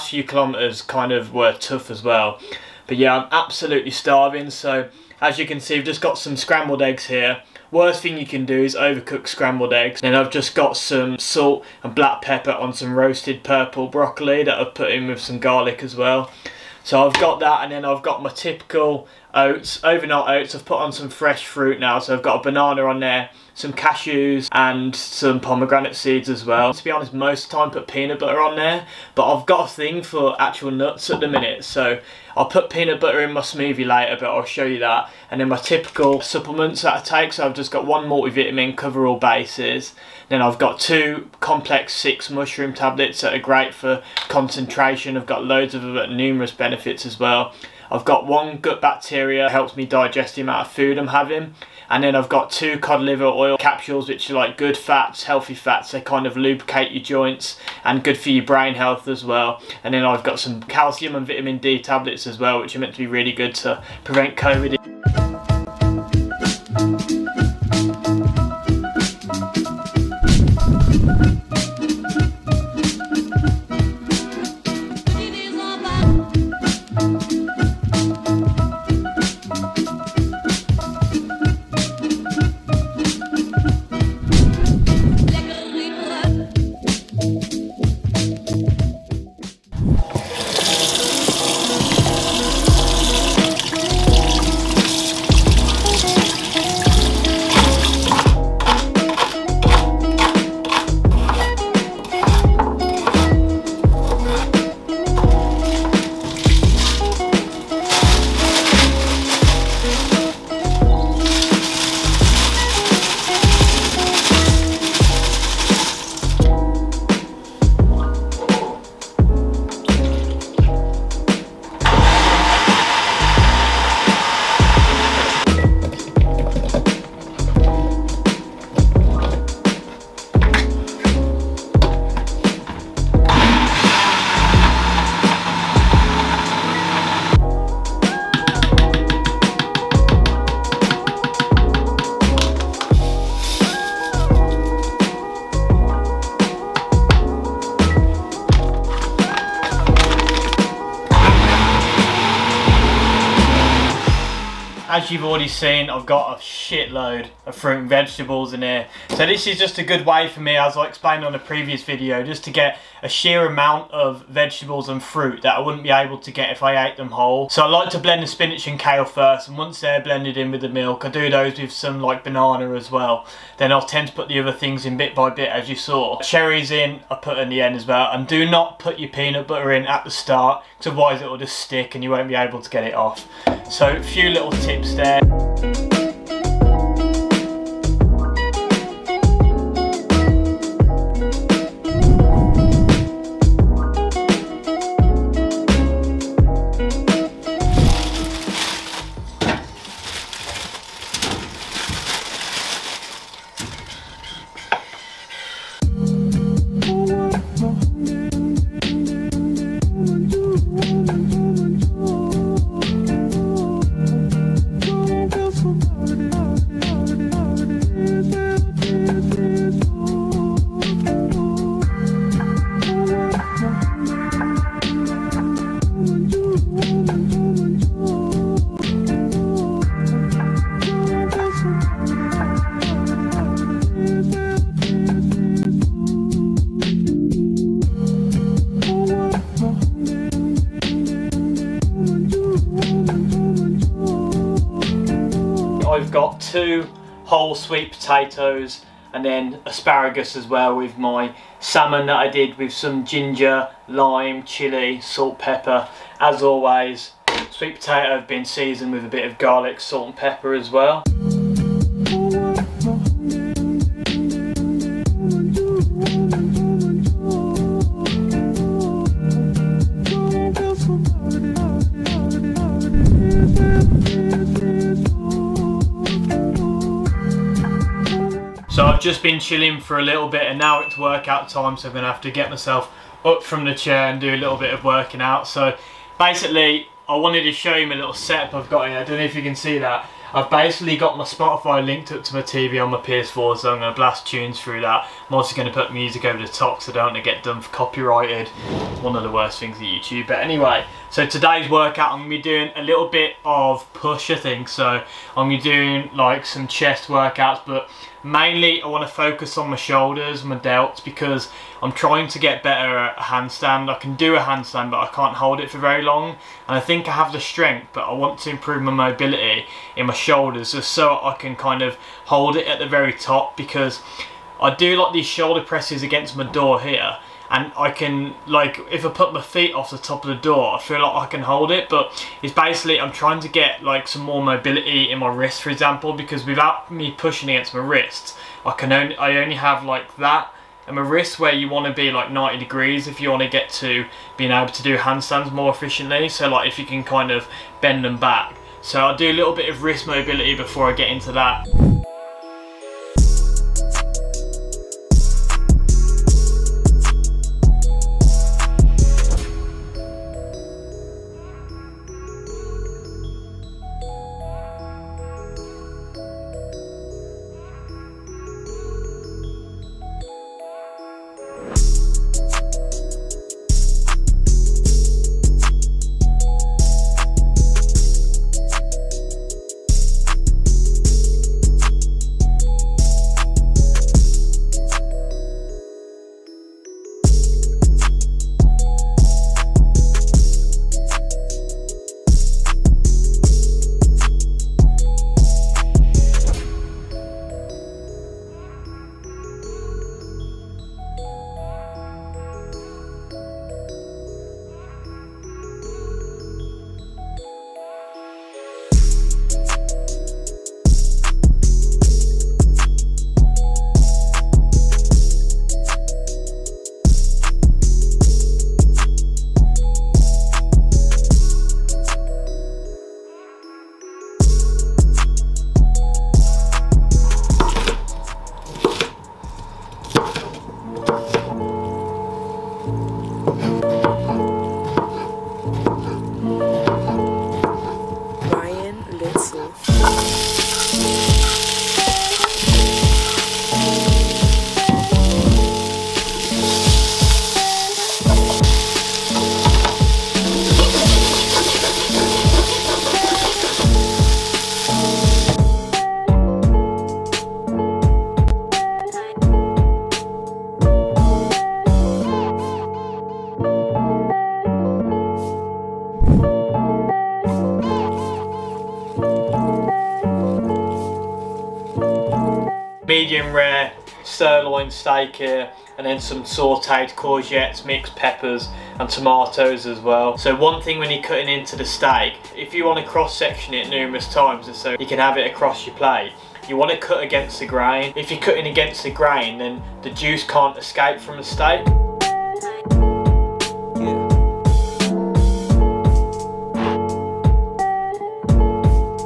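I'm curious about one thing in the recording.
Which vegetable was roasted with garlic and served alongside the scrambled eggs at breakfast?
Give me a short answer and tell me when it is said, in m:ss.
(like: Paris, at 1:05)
purple broccoli, at 0:13.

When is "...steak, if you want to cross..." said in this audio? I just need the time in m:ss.
8:01.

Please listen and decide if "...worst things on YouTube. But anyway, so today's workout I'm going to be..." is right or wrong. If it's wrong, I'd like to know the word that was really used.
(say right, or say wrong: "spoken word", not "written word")
right.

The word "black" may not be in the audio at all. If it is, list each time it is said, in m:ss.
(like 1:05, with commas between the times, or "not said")
0:11.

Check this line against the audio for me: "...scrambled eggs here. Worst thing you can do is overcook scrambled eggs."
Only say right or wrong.
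right.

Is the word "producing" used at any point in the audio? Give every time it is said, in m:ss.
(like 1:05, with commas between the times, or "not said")
not said.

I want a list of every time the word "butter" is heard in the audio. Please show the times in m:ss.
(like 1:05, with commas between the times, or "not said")
0:28, 0:32, 2:59.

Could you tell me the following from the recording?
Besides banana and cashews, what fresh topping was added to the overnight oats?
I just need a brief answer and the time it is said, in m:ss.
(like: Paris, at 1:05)
pomegranate seeds, at 0:25.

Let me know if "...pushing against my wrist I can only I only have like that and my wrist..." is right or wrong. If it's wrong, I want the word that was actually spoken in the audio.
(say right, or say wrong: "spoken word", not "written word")
right.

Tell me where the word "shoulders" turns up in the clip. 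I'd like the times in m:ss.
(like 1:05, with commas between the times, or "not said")
5:09, 5:20, 5:25.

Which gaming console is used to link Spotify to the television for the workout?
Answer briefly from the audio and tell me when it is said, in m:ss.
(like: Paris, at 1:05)
PS4, at 4:53.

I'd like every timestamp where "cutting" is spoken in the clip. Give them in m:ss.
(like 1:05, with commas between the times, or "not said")
8:01, 8:08.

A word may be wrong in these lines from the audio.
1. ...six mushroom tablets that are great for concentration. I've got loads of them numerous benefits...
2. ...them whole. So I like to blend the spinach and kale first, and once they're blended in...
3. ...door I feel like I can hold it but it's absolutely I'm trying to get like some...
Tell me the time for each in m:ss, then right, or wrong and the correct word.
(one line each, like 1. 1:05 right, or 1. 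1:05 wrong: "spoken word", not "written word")
1. 0:41 right
2. 2:46 right
3. 5:30 wrong: "basically", not "absolutely".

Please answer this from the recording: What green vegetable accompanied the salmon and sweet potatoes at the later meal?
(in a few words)
asparagus.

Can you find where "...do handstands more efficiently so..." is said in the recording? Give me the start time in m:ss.
5:44.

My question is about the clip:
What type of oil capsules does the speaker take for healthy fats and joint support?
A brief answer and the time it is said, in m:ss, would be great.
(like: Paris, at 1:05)
cod liver oil, at 0:52.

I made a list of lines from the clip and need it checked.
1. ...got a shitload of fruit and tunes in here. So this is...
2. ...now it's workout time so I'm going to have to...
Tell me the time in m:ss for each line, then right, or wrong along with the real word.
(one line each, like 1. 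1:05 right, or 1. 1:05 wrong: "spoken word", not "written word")
1. 2:36 wrong: "vegetables", not "tunes"
2. 4:40 right.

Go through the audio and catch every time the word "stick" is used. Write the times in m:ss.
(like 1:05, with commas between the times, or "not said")
3:01.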